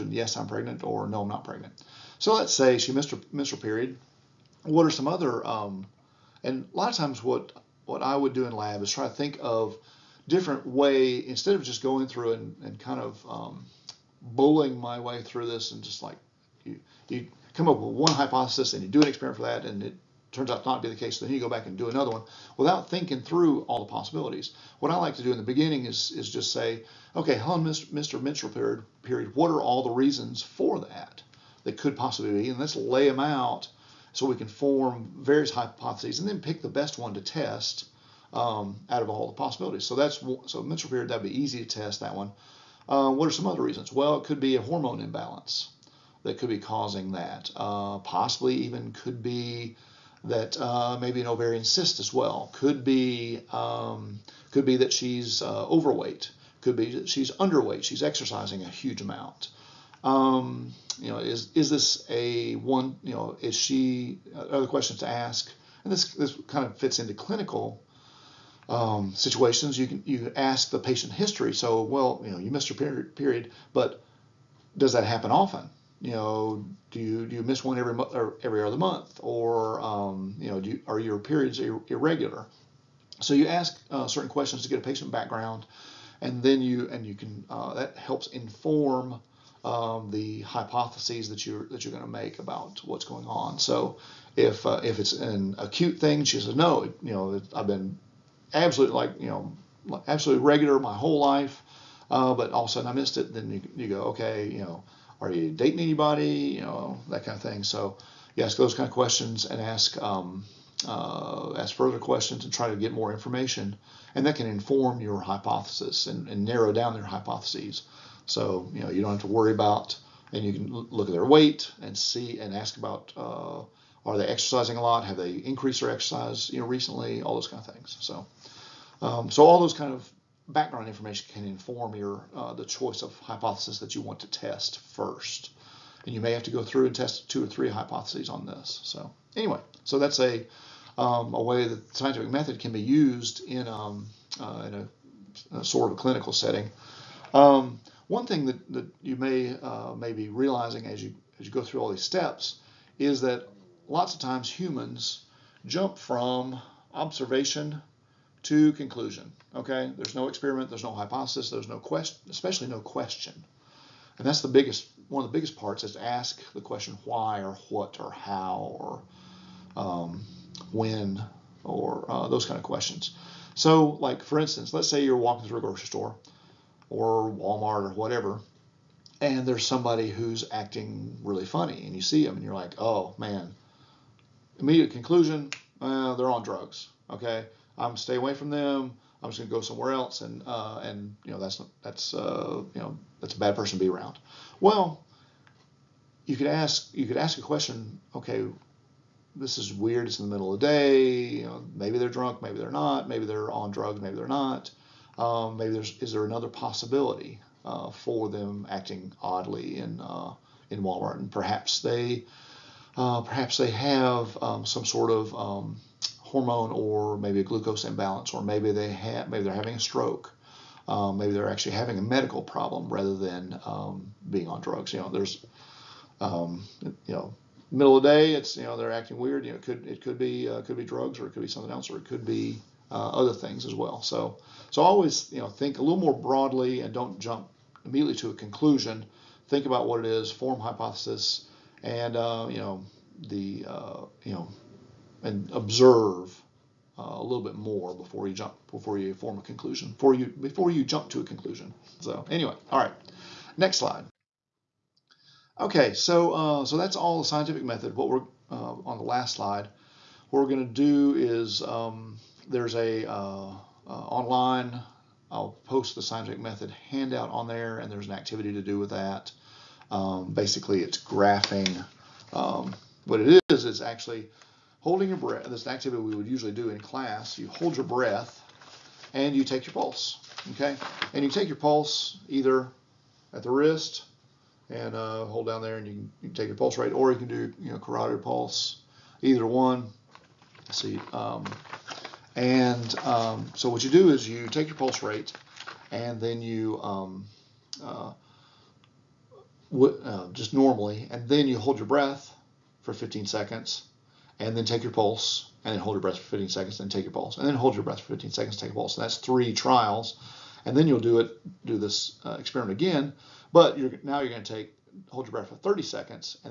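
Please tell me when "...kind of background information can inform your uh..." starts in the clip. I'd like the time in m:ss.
2:09.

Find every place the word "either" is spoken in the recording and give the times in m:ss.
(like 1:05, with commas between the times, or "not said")
4:42, 4:49.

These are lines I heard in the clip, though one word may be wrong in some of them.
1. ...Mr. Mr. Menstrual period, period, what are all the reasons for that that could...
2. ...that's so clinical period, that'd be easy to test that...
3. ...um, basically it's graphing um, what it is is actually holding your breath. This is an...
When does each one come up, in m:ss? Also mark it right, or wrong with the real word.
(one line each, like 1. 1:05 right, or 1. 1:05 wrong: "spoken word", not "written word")
1. 0:27 right
2. 0:39 wrong: "menstrual", not "clinical"
3. 4:29 right.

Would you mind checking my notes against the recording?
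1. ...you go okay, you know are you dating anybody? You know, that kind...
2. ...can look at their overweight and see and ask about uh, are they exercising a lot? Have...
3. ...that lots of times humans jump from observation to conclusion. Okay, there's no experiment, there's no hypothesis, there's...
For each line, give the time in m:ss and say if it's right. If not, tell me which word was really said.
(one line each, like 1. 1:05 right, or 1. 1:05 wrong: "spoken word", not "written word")
1. 1:43 right
2. 2:00 wrong: "weight", not "overweight"
3. 2:33 right.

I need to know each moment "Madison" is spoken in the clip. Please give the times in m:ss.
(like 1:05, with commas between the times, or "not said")
not said.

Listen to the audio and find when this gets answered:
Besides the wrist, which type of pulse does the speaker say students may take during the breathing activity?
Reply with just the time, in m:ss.
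4:47.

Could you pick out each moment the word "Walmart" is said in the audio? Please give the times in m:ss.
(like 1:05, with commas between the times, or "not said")
2:57, 3:30.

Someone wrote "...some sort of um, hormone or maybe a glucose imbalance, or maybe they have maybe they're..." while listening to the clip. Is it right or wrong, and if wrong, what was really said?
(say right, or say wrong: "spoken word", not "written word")
right.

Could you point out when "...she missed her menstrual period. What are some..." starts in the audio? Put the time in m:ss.
0:02.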